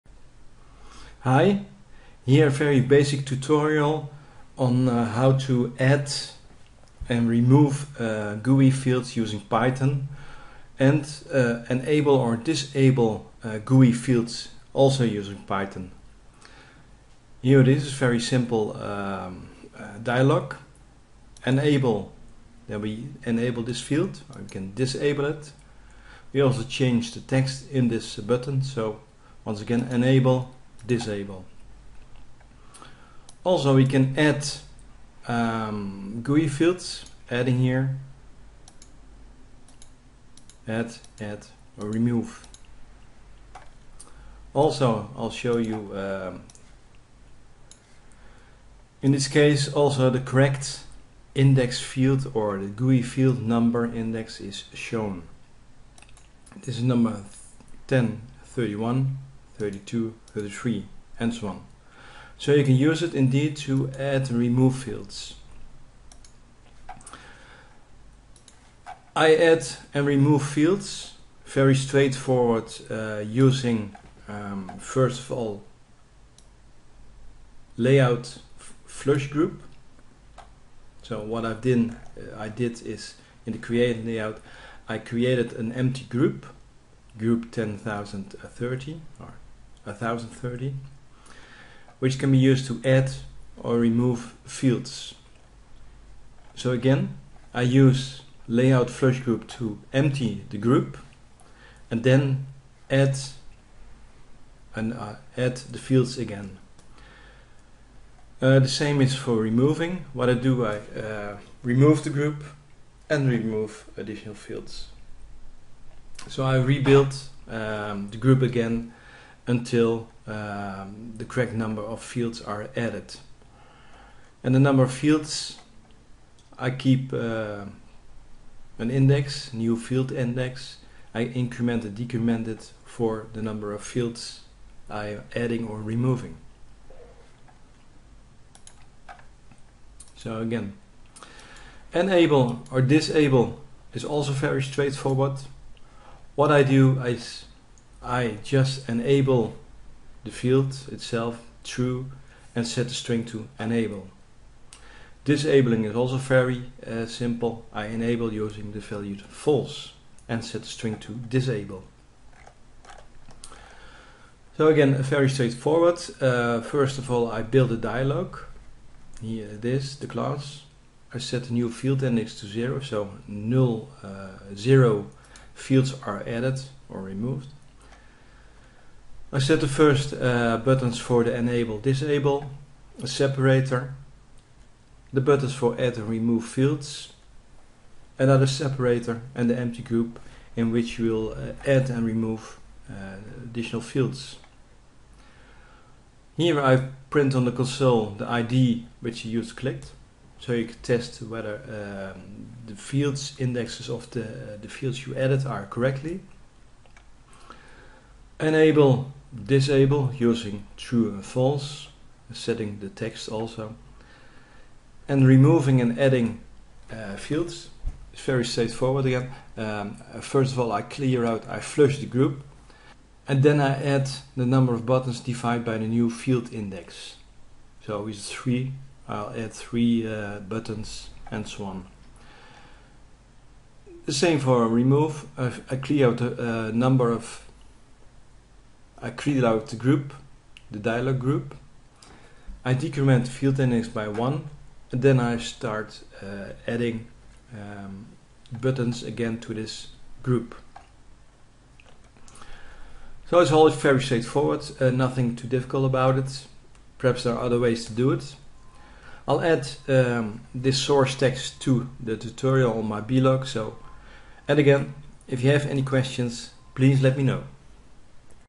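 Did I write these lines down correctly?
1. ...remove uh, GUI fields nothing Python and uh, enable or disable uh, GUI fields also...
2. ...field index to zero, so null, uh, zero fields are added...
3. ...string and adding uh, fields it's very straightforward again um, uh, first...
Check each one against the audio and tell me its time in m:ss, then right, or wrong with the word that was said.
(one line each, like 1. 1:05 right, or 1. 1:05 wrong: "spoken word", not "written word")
1. 0:07 wrong: "using", not "nothing"
2. 2:51 right
3. 3:35 wrong: "removing", not "string".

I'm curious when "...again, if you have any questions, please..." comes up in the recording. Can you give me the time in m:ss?
4:24.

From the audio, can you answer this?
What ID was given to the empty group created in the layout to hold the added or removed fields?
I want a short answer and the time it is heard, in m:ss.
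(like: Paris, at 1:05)
1030, at 1:29.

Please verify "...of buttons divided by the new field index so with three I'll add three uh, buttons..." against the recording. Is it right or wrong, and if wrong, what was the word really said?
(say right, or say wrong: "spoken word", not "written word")
right.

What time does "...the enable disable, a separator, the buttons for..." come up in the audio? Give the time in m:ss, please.
3:01.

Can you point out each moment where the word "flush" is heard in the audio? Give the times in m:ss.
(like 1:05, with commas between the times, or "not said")
1:18, 1:38, 3:41.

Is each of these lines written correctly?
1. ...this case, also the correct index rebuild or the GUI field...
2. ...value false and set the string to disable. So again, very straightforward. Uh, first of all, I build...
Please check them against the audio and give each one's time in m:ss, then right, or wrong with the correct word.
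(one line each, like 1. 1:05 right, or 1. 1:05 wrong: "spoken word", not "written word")
1. 0:49 wrong: "field", not "rebuild"
2. 2:38 right.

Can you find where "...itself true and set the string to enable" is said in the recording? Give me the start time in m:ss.
2:30.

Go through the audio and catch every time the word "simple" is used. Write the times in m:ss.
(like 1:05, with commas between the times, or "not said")
0:18, 2:37.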